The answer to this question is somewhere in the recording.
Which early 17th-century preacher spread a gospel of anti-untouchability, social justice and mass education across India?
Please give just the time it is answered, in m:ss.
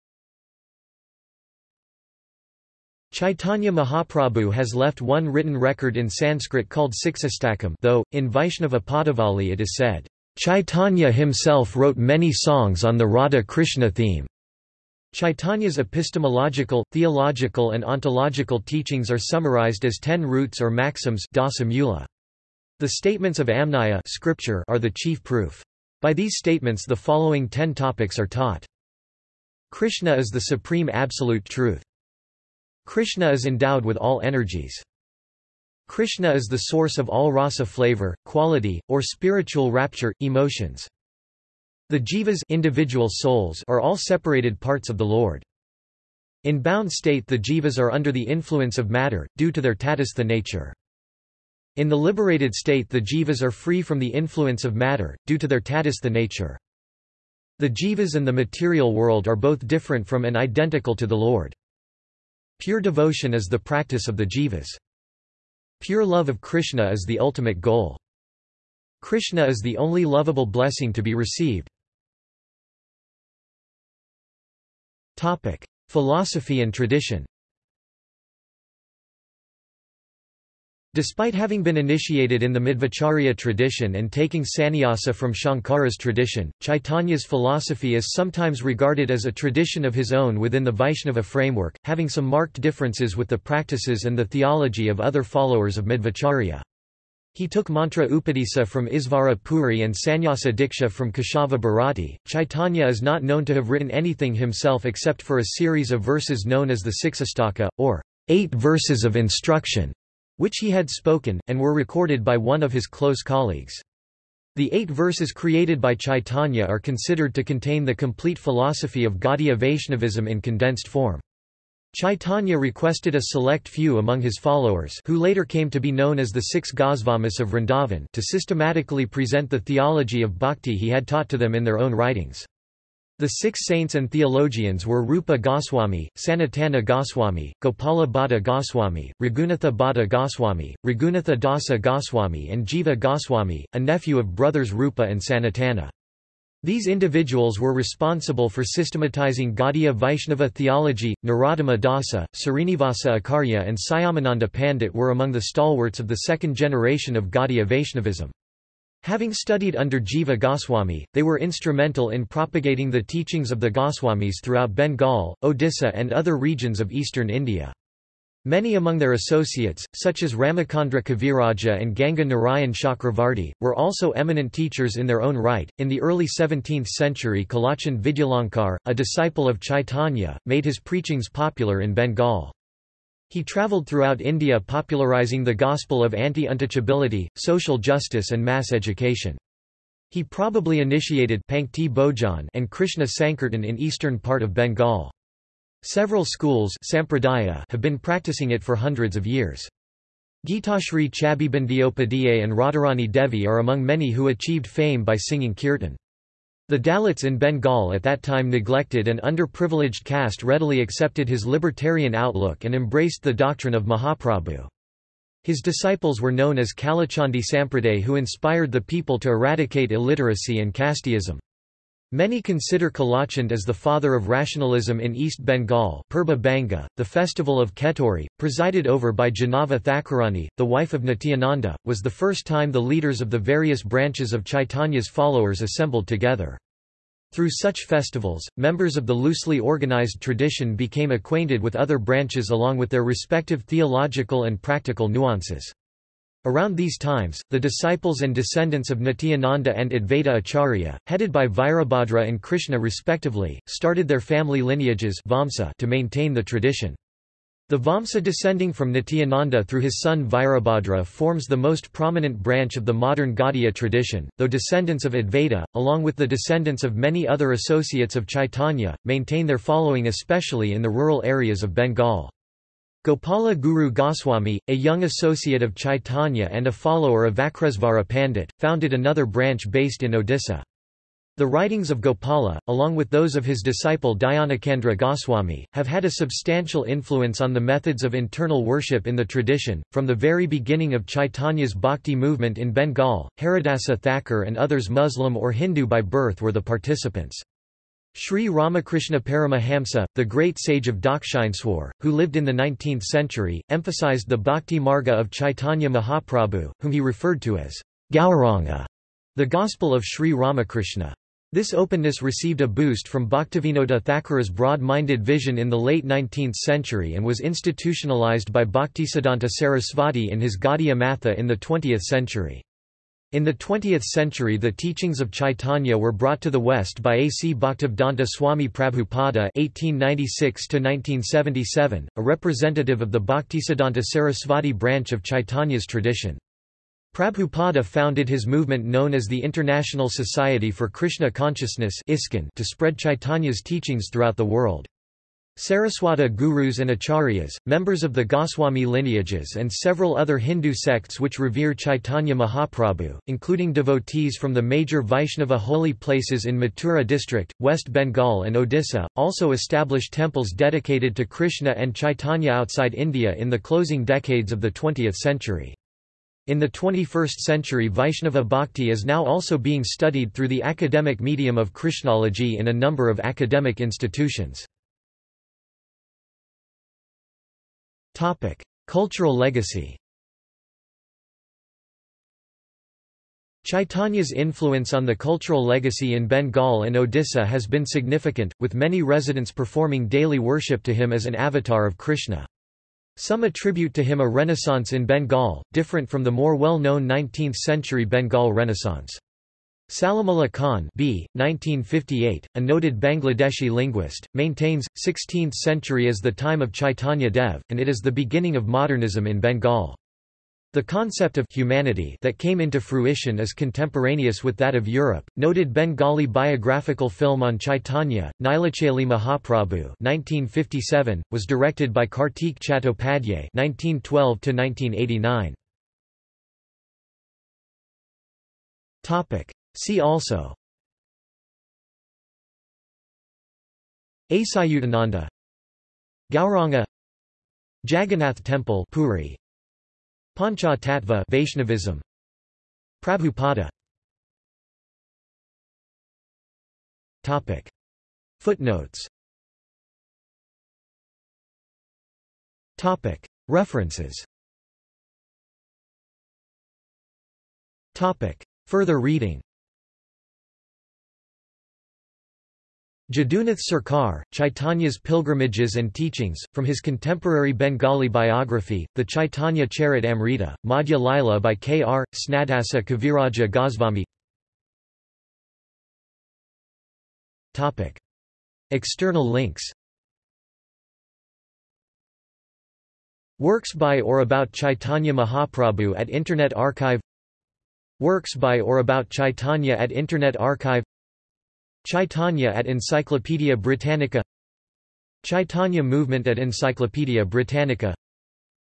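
2:57.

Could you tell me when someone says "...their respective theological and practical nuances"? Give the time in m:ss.
4:02.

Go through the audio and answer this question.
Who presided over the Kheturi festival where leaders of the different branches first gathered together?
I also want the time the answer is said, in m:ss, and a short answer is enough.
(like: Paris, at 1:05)
Jahnava Thakurani, at 3:49.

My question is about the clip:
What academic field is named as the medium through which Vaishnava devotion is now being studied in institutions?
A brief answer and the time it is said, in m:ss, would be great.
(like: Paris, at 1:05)
Krishnology, at 6:11.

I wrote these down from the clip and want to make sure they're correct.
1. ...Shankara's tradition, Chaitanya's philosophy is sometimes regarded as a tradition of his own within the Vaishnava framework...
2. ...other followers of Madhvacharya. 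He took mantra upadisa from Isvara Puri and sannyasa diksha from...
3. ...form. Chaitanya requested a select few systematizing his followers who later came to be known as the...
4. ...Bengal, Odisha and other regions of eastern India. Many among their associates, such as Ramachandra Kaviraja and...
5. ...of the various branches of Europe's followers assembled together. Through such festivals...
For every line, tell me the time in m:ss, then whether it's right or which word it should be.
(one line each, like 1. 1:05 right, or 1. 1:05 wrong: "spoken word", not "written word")
1. 1:25 right
2. 1:35 right
3. 2:00 wrong: "among", not "systematizing"
4. 2:44 right
5. 3:53 wrong: "Chaitanya", not "Europe".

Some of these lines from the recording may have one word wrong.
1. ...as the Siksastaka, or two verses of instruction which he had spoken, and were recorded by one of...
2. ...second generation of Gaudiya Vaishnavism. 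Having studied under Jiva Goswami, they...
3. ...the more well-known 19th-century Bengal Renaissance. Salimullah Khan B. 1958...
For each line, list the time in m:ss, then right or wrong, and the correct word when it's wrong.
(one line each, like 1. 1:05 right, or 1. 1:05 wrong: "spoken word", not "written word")
1. 1:46 wrong: "eight", not "two"
2. 2:36 right
3. 6:36 right.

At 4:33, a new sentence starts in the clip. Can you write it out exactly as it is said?
Gopala Guru Goswami, a young associate of Chaitanya and a follower of Vakresvara Pandit, founded another branch based in Odisha.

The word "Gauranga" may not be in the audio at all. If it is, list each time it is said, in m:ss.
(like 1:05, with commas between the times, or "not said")
5:08, 7:16.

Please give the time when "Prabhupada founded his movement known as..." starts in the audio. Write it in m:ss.
5:37.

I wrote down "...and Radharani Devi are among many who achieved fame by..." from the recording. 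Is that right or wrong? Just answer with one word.
right.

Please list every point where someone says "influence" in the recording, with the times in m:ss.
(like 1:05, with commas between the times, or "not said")
0:48, 0:54, 4:46, 6:24.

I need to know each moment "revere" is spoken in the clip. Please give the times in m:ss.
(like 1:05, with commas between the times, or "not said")
5:51.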